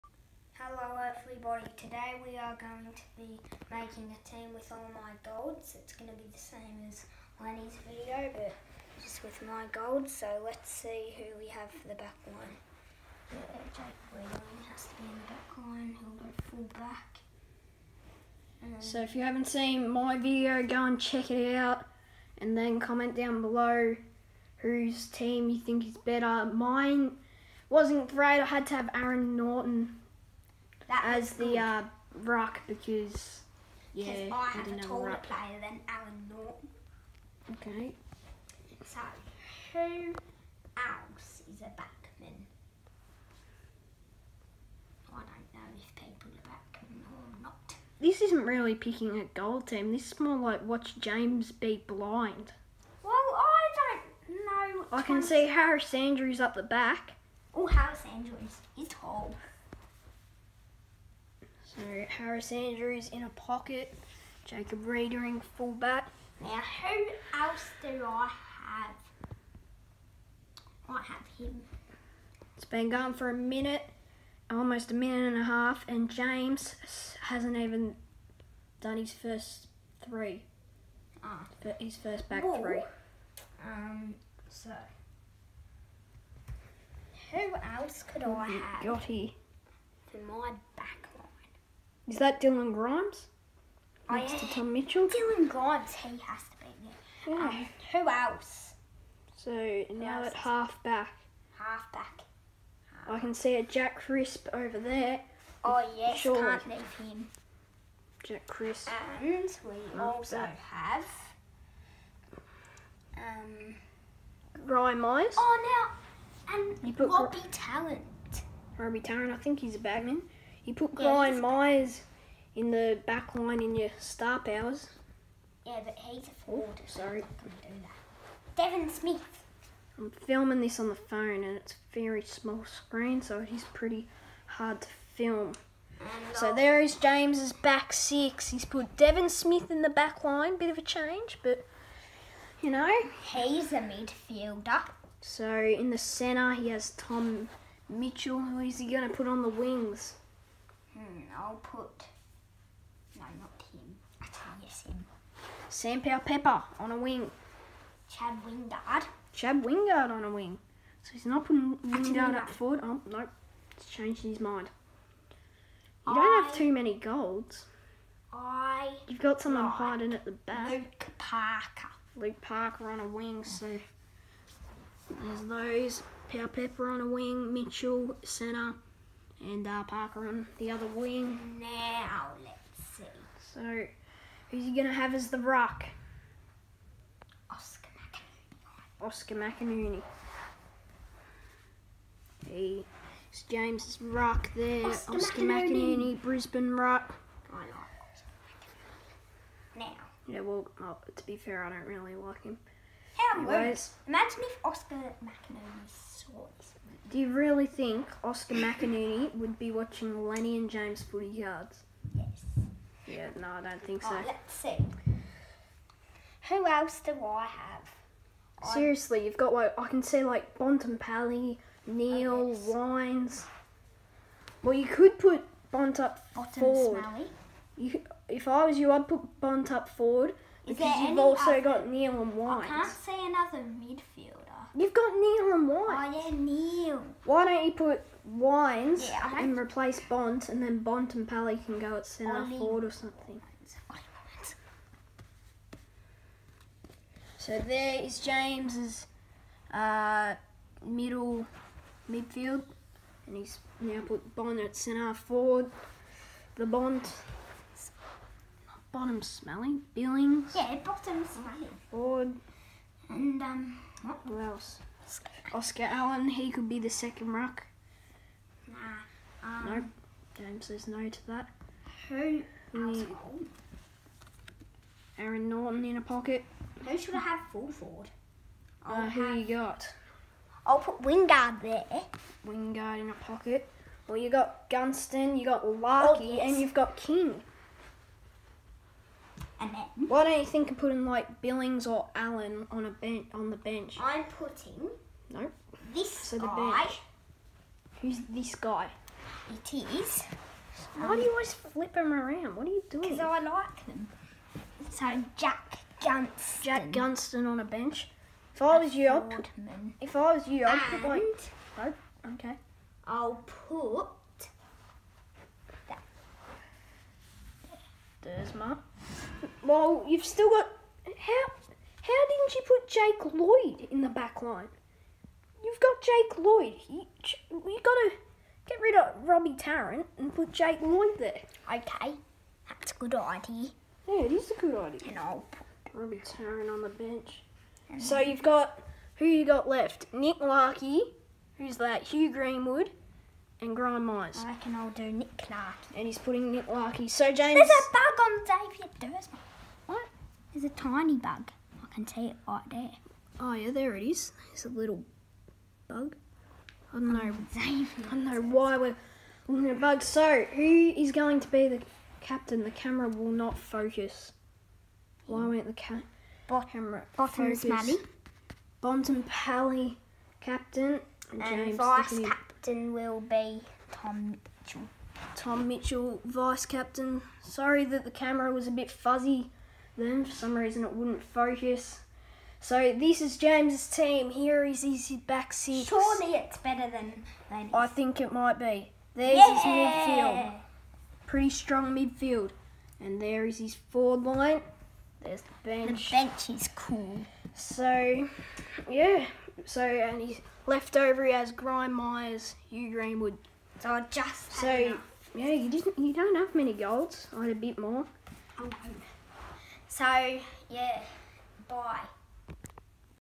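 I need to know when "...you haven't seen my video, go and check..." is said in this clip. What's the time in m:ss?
0:19.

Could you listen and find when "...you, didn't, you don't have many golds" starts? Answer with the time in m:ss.
6:45.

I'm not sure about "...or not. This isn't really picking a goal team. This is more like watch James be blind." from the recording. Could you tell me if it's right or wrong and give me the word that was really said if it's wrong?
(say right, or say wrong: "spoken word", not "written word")
right.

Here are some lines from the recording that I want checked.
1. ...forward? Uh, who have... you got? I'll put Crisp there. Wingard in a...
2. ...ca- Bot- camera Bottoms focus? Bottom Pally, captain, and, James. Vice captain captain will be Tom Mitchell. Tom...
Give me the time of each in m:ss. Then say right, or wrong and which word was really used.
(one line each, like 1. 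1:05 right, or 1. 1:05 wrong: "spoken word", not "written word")
1. 4:37 wrong: "Wingard", not "Crisp"
2. 6:05 right.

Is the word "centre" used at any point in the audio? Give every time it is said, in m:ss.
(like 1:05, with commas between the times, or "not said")
2:25, 2:58, 4:02, 4:14.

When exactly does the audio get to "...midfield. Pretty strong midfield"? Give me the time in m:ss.
6:29.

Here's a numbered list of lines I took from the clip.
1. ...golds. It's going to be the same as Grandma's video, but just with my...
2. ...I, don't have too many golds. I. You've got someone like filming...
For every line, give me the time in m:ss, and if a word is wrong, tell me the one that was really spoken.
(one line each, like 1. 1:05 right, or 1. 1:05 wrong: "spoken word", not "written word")
1. 0:05 wrong: "Lenny", not "Grandma"
2. 2:46 wrong: "hiding", not "filming".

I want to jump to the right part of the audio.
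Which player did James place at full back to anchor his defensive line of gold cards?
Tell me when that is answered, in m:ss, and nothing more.
1:04.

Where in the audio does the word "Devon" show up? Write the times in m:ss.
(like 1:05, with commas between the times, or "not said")
2:08, 2:18.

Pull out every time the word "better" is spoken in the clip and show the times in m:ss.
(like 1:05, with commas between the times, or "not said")
0:25, 6:26.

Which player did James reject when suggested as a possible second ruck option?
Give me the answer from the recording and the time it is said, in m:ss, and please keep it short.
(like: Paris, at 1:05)
Oscar Allen, at 4:25.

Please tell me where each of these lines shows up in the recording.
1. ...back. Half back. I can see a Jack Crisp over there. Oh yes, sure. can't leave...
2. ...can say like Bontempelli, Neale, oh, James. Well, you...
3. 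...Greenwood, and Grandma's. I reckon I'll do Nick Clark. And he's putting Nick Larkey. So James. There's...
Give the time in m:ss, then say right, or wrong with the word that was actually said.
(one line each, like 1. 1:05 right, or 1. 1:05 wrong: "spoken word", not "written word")
1. 1:40 right
2. 3:39 wrong: "Wines", not "James"
3. 5:42 right.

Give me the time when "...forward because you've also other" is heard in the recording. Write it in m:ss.
3:49.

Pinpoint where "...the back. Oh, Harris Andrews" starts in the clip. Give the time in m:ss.
0:56.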